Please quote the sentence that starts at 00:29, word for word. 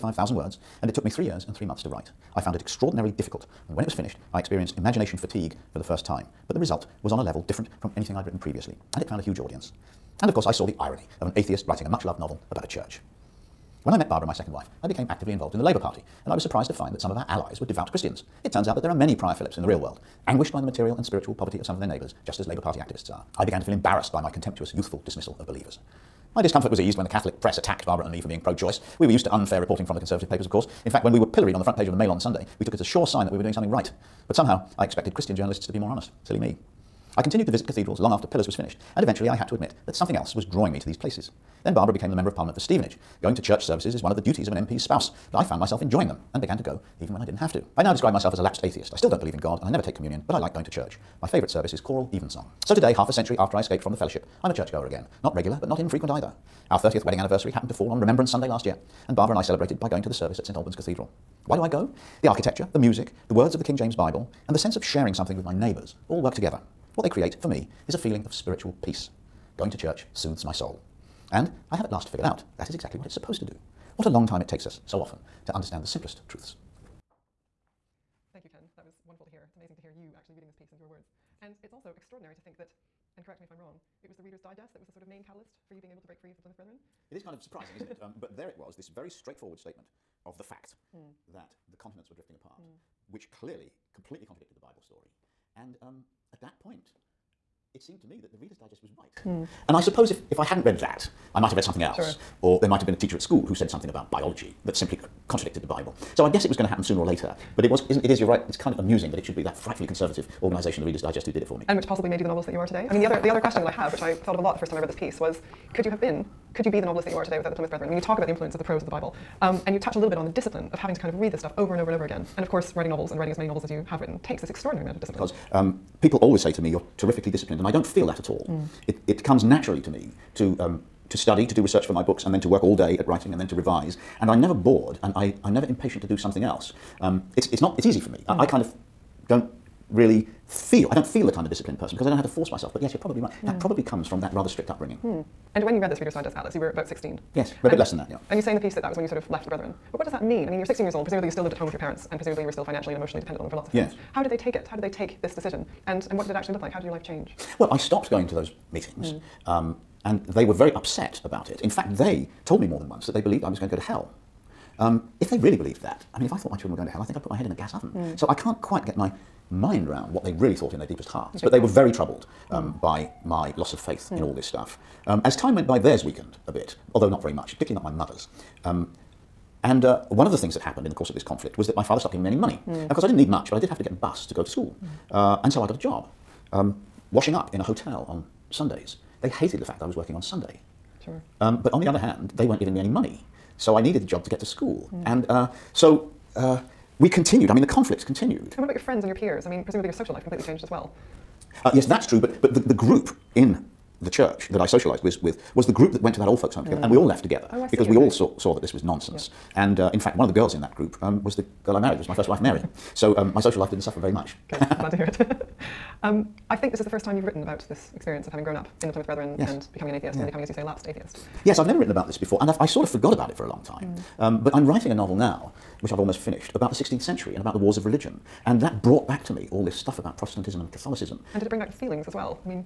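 We were used to unfair reporting from the Conservative papers, of course.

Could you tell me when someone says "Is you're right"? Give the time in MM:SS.
01:48.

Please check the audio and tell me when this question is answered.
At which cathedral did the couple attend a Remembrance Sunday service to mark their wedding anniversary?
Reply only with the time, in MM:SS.
01:00.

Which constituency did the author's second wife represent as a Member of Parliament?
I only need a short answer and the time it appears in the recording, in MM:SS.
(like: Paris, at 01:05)
Stevenage, at 00:42.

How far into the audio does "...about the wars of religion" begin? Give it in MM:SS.
03:47.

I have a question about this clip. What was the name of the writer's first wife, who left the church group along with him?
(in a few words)
Mary.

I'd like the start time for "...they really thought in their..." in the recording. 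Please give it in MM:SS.
02:50.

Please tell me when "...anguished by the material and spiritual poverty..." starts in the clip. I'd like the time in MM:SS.
00:20.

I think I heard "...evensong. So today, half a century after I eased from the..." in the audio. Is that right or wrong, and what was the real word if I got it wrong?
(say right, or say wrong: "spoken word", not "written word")
wrong: "escaped", not "eased".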